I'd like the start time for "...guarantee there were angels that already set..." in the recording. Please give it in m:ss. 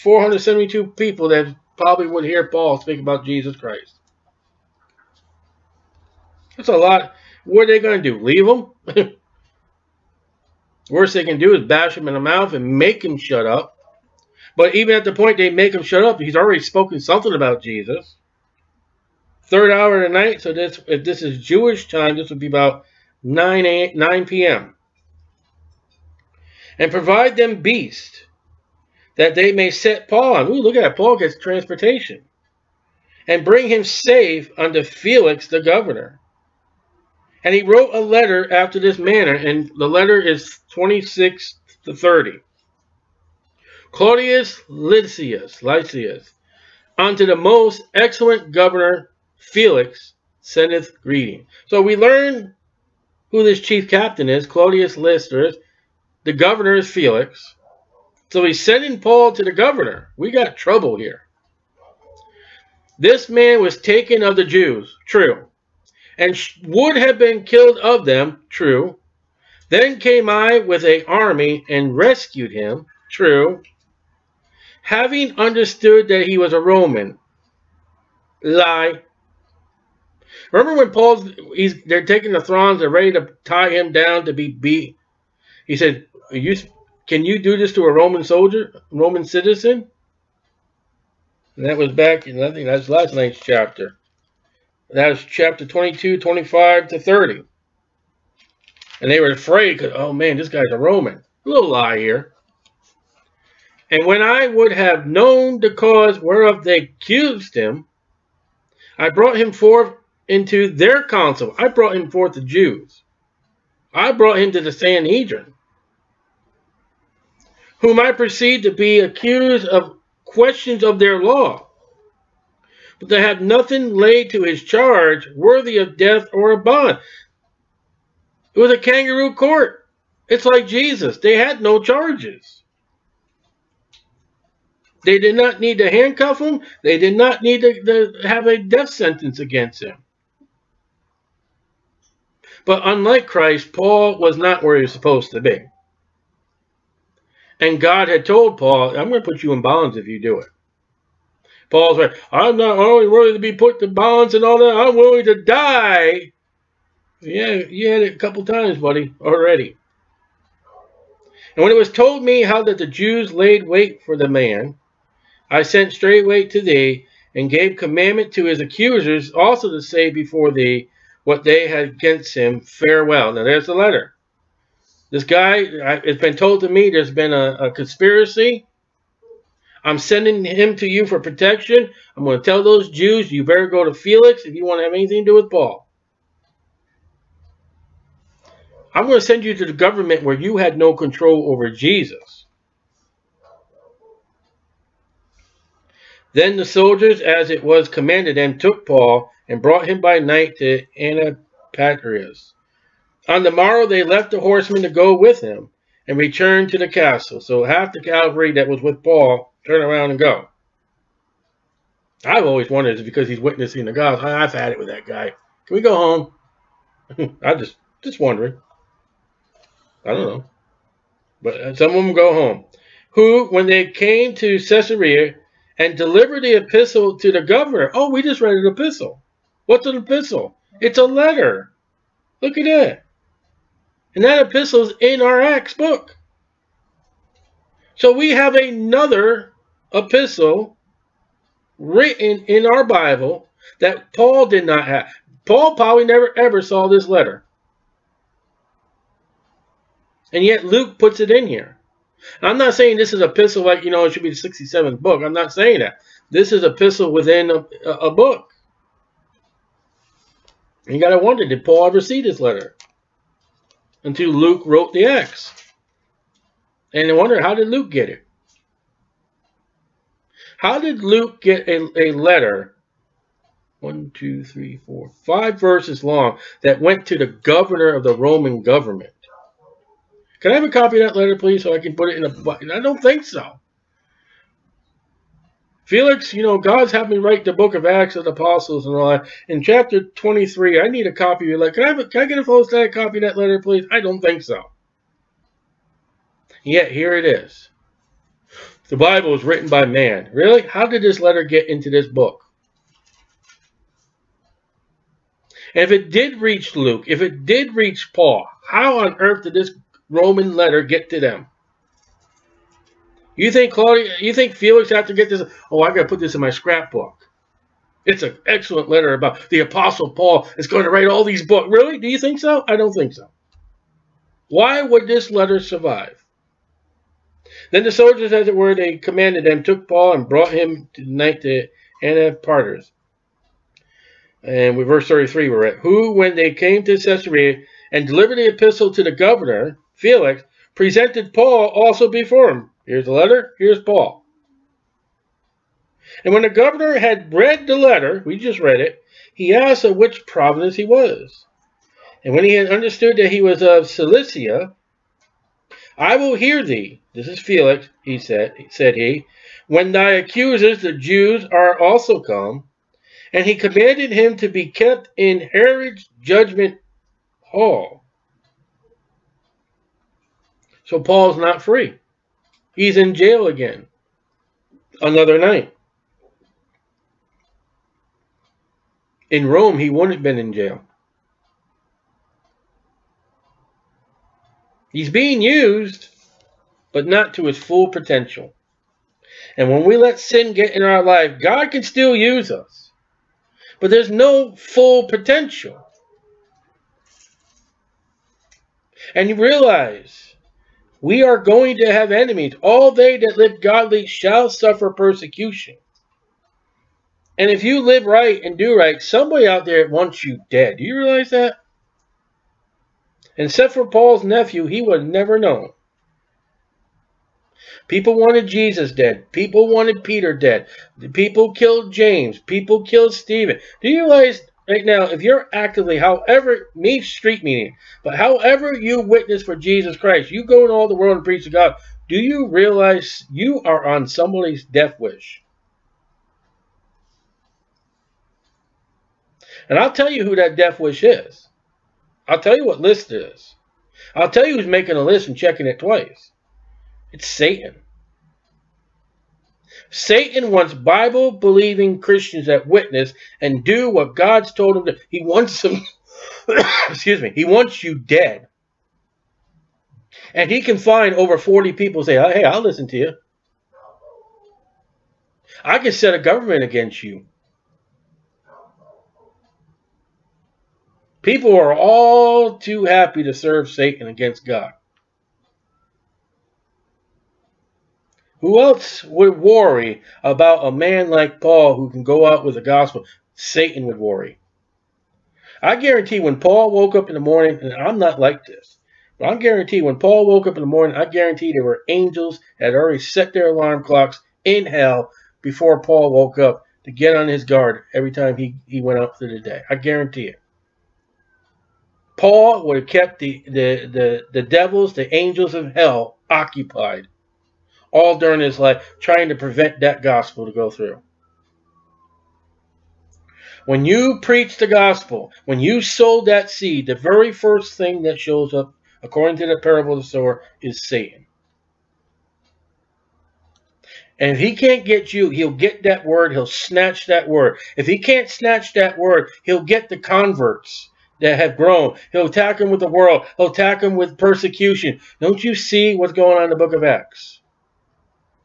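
8:11.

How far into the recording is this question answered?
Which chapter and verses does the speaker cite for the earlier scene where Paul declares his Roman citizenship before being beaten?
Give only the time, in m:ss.
1:35.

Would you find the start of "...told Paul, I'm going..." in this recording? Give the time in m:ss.
2:28.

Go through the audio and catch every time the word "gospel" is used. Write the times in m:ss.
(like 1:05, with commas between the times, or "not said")
8:02, 8:30, 8:34.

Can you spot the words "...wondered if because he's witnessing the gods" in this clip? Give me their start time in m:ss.
3:32.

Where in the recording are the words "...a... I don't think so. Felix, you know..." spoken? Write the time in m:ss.
4:42.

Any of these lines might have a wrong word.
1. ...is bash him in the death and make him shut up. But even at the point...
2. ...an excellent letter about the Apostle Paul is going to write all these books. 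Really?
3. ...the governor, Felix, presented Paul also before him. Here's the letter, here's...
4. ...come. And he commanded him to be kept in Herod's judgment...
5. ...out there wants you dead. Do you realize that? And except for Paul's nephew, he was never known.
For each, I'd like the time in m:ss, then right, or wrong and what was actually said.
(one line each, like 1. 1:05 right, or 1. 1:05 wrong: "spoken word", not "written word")
1. 0:11 wrong: "mouth", not "death"
2. 5:18 right
3. 5:39 right
4. 6:02 right
5. 6:49 right.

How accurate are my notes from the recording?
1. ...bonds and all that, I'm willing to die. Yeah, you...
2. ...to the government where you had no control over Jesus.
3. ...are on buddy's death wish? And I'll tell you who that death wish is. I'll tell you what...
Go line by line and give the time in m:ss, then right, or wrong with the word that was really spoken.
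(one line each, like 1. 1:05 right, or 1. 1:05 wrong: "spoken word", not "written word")
1. 2:33 right
2. 3:09 right
3. 7:13 wrong: "somebody", not "buddy".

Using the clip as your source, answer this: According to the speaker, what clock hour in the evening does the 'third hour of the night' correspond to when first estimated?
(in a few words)
about 9.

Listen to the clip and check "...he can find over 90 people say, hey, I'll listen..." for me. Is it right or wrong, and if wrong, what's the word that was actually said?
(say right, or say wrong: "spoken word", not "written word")
wrong: "40", not "90".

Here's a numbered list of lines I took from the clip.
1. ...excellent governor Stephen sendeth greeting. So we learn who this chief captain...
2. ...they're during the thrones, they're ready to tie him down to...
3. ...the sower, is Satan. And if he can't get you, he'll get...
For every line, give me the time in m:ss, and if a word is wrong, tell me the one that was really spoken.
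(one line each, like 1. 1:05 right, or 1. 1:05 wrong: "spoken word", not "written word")
1. 0:47 wrong: "Felix", not "Stephen"
2. 1:21 wrong: "taking", not "during"
3. 8:39 right.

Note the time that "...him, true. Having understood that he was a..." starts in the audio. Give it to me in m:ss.
1:12.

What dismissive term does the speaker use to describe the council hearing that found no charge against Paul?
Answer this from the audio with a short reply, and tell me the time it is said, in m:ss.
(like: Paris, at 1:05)
kangaroo court, at 2:08.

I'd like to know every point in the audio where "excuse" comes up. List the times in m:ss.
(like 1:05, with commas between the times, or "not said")
7:36.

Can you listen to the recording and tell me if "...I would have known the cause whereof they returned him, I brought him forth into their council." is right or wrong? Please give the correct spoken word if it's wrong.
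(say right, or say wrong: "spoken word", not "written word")
wrong: "accused", not "returned".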